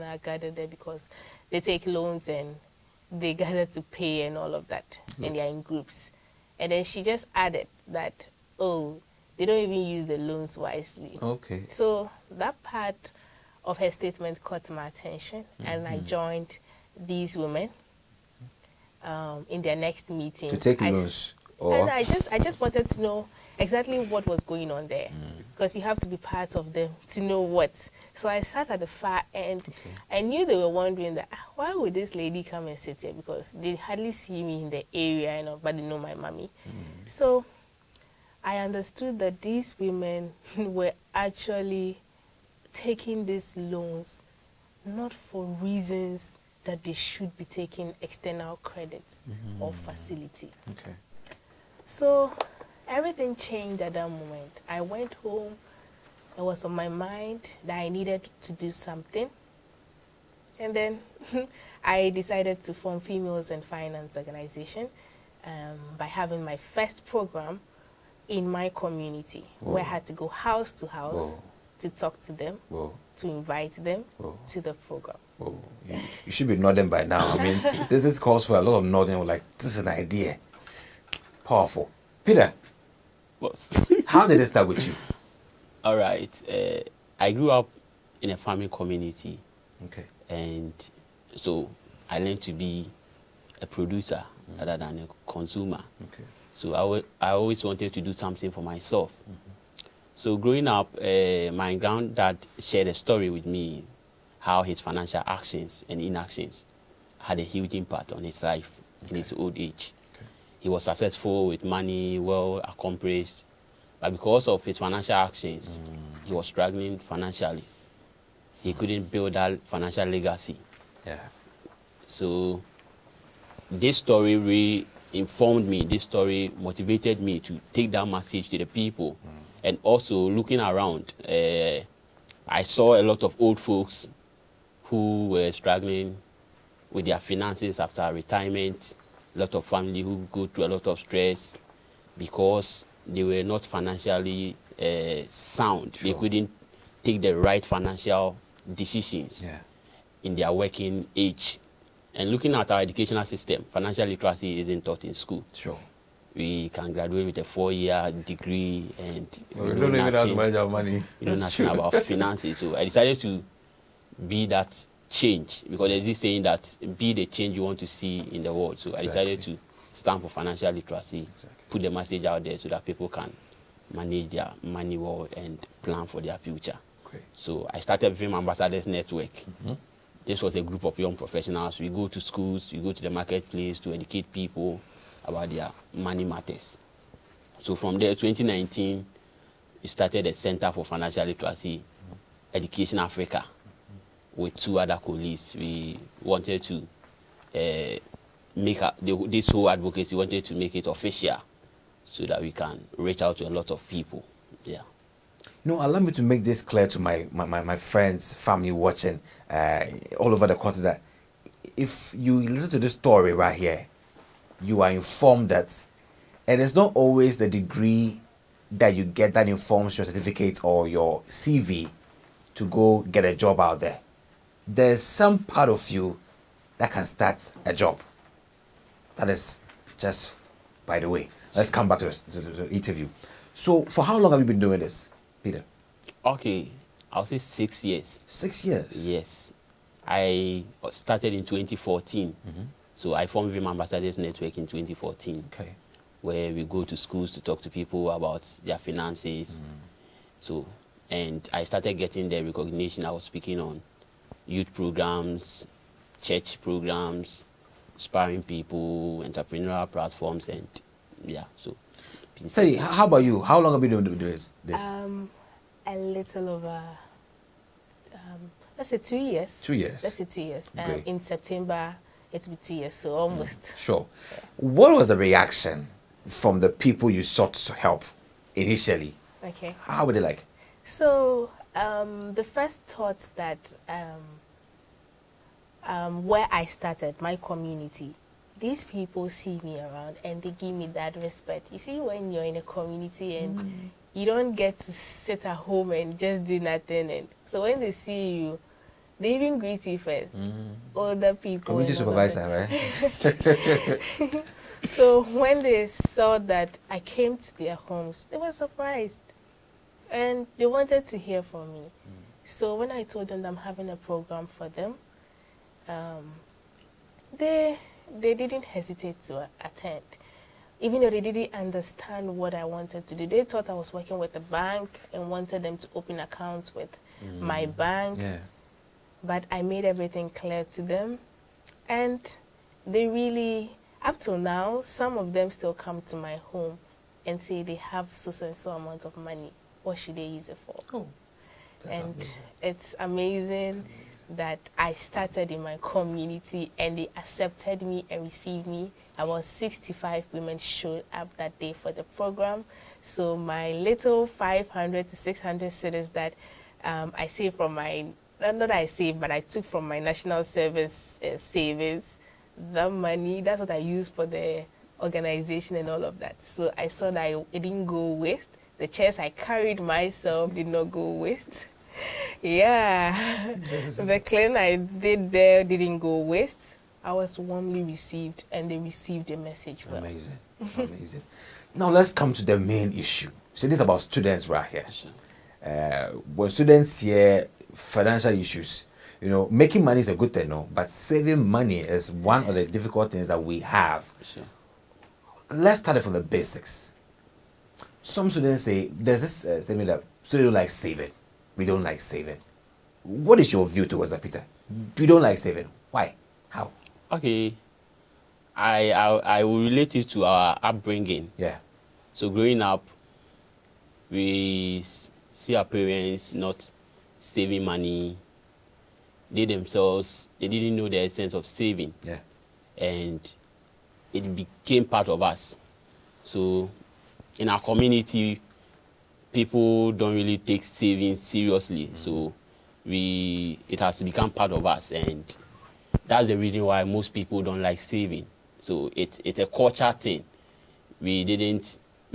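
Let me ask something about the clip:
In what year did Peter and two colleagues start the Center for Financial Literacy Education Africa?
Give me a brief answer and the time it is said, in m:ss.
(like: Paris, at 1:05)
2019, at 3:08.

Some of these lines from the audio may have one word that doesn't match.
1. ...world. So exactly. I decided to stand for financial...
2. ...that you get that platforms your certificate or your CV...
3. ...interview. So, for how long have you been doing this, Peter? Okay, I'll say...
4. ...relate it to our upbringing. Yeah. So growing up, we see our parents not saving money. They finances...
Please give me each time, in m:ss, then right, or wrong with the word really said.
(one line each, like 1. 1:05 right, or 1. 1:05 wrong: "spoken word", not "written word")
1. 2:48 right
2. 3:38 wrong: "informs", not "platforms"
3. 3:52 right
4. 6:49 wrong: "themselves", not "finances".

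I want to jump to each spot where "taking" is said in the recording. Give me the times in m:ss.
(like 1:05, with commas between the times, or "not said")
0:42, 0:47.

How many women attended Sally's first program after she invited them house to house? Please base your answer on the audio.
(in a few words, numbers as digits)
65.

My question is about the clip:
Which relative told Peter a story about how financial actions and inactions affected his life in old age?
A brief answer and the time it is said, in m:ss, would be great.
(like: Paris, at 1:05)
granddad, at 1:41.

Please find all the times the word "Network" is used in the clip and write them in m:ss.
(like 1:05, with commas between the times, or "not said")
2:58, 4:04.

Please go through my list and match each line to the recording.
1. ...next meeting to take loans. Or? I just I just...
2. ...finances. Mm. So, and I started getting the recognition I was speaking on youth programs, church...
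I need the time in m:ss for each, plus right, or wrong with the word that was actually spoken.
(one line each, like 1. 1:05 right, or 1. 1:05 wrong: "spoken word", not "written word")
1. 0:19 right
2. 4:08 right.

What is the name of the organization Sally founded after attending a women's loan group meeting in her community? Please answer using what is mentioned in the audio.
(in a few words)
Females and Finance Organization.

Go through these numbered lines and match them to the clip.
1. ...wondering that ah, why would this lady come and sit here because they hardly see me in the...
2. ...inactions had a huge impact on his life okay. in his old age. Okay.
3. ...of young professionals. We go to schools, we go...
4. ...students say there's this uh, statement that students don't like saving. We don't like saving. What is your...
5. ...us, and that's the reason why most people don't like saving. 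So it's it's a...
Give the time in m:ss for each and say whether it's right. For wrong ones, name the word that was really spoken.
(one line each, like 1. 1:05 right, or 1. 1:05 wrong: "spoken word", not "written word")
1. 0:30 right
2. 1:45 right
3. 3:00 right
4. 6:38 right
5. 7:14 right.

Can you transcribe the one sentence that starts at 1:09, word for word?
where I had to go house to house Whoa.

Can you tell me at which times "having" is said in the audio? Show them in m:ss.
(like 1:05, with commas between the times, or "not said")
1:06, 5:13.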